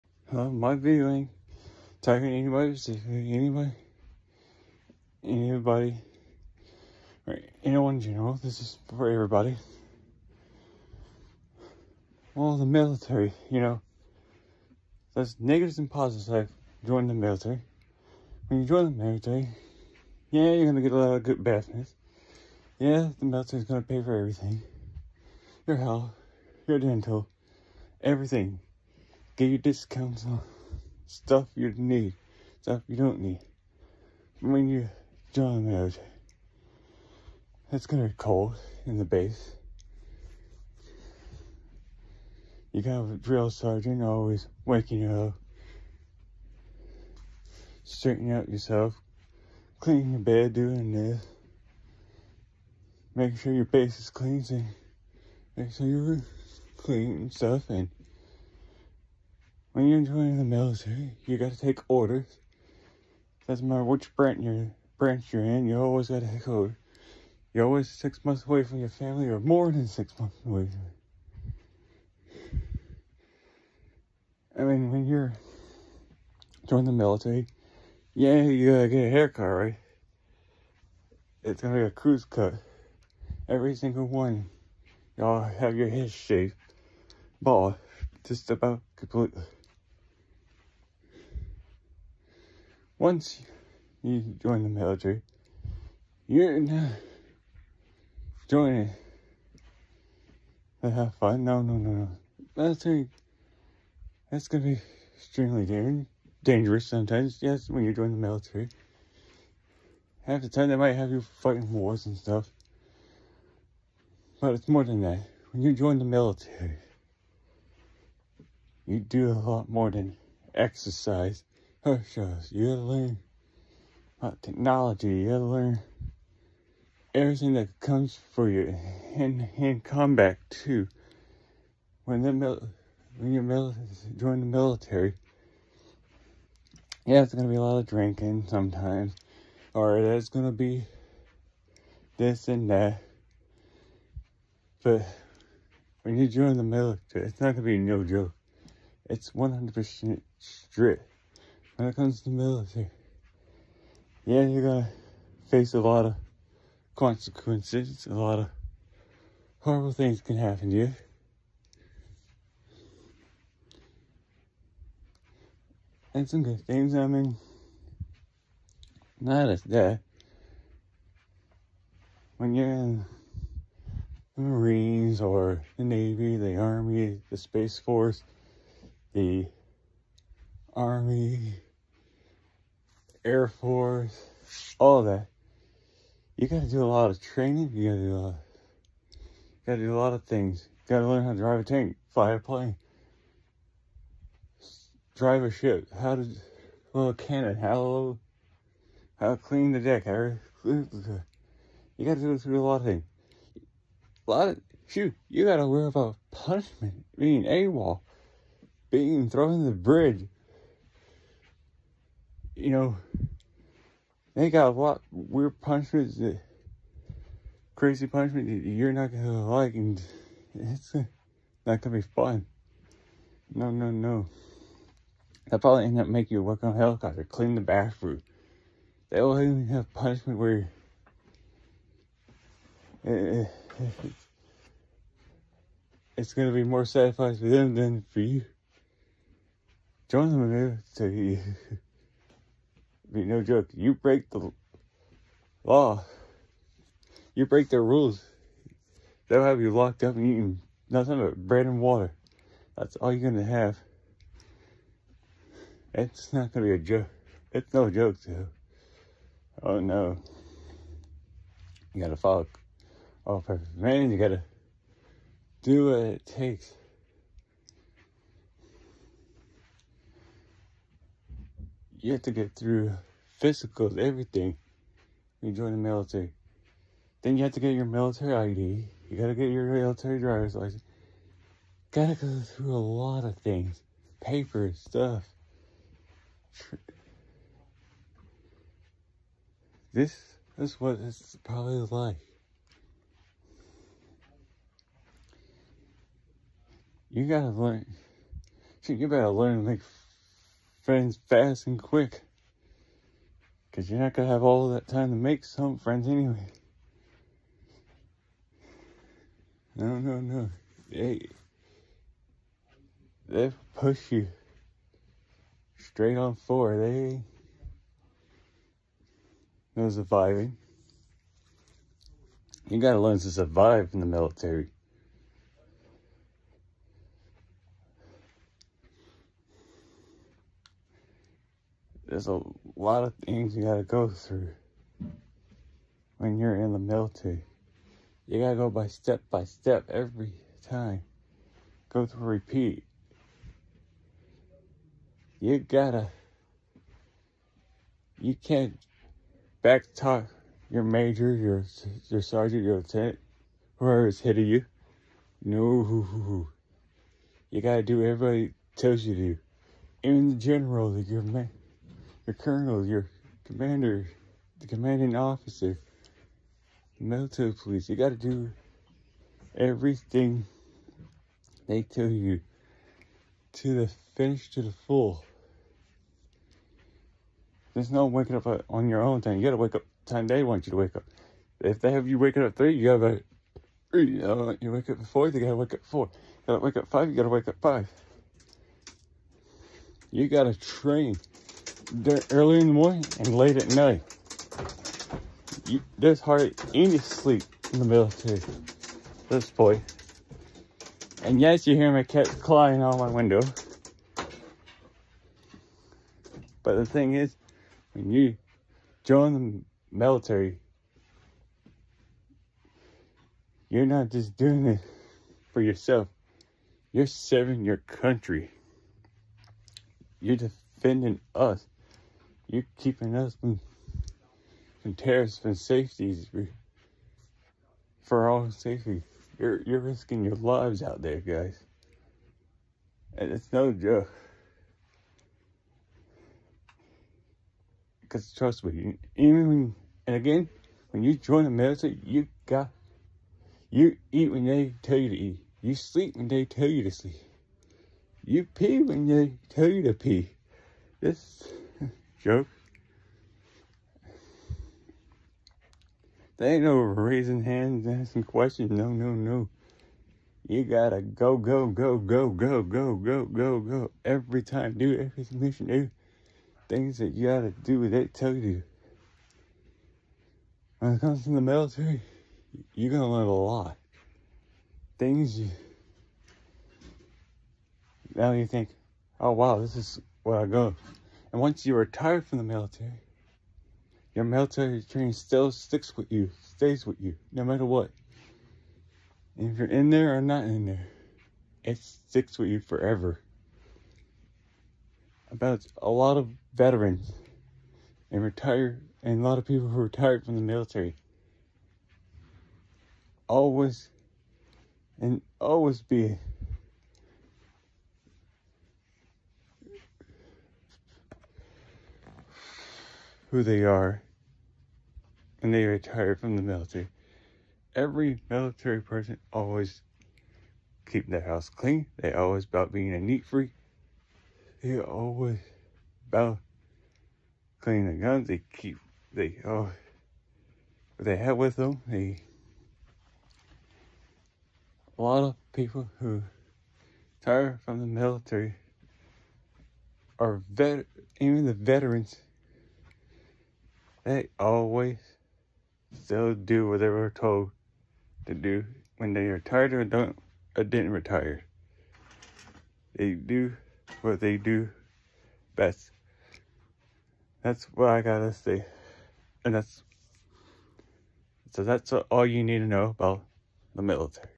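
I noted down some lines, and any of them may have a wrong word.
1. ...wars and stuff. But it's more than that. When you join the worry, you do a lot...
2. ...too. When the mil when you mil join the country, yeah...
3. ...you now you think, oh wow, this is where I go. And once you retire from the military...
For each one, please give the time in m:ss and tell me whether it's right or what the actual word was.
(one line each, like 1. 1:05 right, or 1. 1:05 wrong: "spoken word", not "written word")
1. 1:51 wrong: "military", not "worry"
2. 2:10 wrong: "military", not "country"
3. 7:55 right.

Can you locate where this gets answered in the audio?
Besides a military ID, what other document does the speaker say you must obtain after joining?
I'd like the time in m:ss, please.
4:39.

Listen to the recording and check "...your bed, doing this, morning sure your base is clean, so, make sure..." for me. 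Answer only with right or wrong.
wrong.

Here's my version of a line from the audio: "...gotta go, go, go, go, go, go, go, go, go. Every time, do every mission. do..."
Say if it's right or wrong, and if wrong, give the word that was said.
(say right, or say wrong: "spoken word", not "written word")
right.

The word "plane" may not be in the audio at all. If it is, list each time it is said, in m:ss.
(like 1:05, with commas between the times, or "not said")
3:12.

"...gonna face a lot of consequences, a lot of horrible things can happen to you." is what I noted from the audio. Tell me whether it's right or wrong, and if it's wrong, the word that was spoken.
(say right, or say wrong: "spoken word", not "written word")
right.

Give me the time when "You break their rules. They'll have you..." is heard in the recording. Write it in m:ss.
4:07.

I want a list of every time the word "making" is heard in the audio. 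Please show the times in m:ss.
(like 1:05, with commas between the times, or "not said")
0:53, 3:46.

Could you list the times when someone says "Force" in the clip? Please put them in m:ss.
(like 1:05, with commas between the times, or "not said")
2:57, 3:03.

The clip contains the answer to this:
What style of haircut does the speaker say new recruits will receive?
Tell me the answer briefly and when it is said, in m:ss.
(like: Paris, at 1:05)
Crew cut, at 1:21.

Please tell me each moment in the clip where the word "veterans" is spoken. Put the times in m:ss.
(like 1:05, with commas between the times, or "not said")
8:16, 9:01.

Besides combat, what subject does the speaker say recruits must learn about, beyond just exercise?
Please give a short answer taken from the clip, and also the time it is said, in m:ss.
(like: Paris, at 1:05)
Technology, at 2:04.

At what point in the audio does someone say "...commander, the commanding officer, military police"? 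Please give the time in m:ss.
6:03.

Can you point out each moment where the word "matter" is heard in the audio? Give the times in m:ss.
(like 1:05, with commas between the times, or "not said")
1:03, 8:07.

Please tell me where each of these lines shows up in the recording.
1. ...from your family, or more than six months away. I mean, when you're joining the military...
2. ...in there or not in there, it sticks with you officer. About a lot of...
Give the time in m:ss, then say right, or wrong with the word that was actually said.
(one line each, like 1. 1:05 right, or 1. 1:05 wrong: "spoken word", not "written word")
1. 1:08 right
2. 8:09 wrong: "forever", not "officer".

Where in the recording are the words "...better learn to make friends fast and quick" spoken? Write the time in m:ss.
4:59.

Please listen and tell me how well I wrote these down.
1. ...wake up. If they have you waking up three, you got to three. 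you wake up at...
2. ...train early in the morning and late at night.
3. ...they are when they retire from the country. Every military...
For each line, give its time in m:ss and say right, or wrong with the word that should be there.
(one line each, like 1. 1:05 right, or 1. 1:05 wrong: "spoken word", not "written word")
1. 6:20 right
2. 6:30 right
3. 8:33 wrong: "military", not "country".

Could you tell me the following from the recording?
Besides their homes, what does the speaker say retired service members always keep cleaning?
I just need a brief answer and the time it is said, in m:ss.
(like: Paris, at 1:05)
Guns, at 8:48.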